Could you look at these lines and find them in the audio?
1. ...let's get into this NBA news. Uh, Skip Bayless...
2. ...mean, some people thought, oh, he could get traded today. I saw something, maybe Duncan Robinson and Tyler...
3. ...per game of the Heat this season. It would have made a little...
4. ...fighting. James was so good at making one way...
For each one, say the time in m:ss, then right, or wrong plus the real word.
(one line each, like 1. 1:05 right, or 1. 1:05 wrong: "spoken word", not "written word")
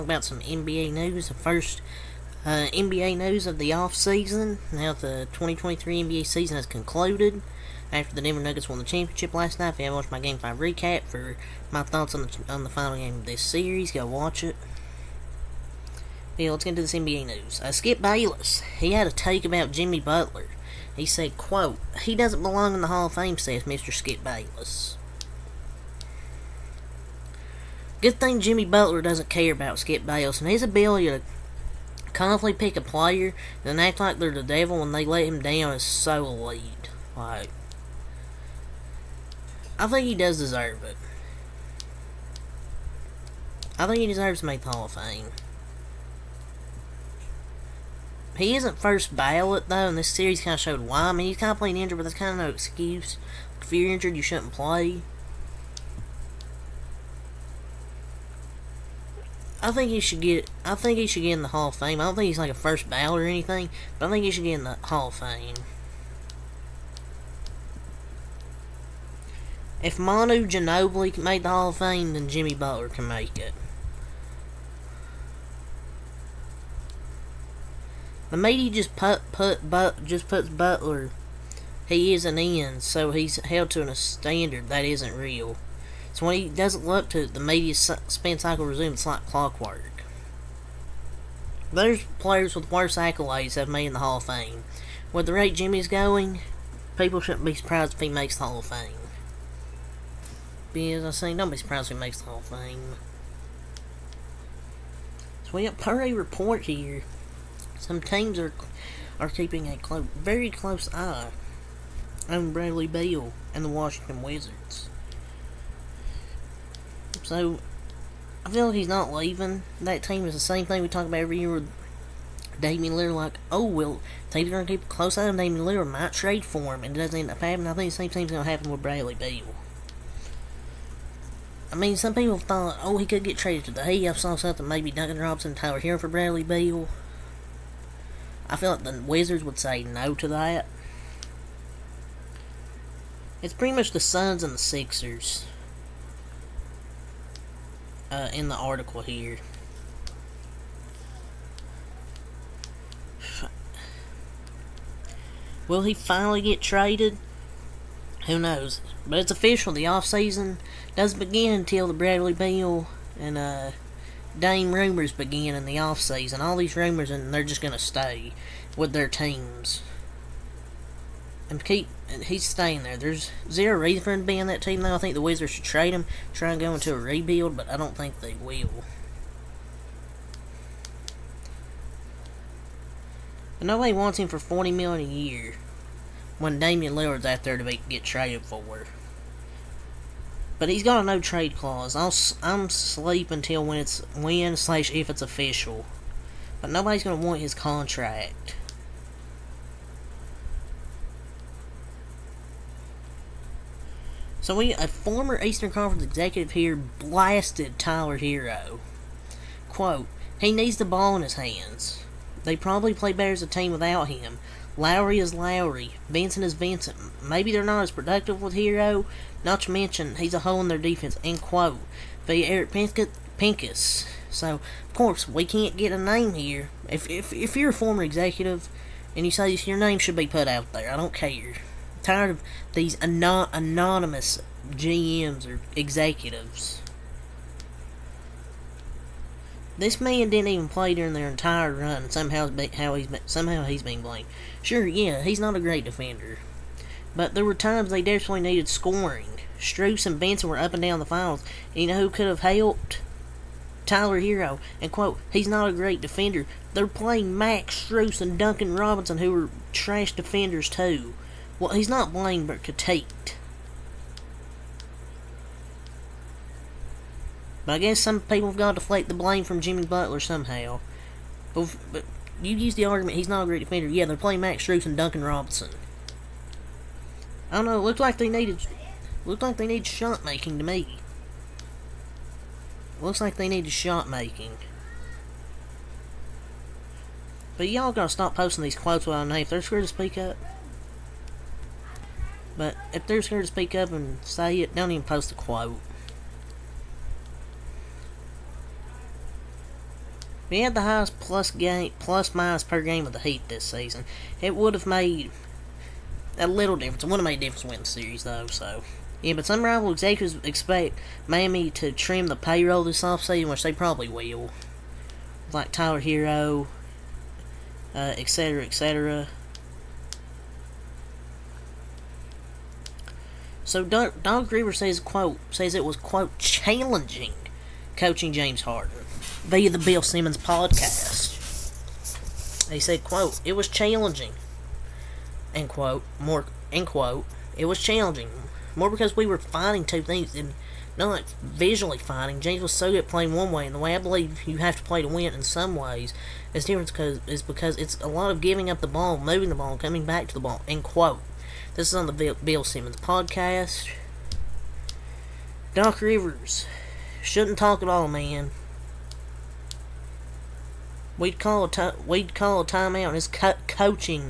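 1. 0:16 right
2. 2:11 right
3. 5:02 right
4. 5:41 wrong: "playing", not "making".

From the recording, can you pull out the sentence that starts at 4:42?
Looks like they needed shot making.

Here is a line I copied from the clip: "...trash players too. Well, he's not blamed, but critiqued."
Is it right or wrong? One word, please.
wrong.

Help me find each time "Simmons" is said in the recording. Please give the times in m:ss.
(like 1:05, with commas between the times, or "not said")
5:30, 5:52.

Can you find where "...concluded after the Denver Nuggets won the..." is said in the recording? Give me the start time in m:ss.
0:06.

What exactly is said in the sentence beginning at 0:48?
He isn't first ballot, though, and this series kind of showed why.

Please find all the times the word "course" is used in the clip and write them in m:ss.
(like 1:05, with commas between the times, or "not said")
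3:44.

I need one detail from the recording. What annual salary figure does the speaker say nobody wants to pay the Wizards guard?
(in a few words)
40 million.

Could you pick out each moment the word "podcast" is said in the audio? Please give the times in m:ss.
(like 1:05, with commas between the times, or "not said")
5:30, 5:52.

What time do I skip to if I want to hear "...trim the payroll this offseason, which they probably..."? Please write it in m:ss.
5:11.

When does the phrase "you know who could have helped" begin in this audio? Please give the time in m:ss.
4:11.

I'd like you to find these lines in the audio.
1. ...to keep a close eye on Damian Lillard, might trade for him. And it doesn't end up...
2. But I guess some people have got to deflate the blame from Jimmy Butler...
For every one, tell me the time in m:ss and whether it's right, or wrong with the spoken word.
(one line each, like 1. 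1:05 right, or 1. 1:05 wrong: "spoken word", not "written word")
1. 2:04 right
2. 4:27 right.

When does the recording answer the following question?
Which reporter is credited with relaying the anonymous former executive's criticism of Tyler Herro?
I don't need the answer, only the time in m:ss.
3:42.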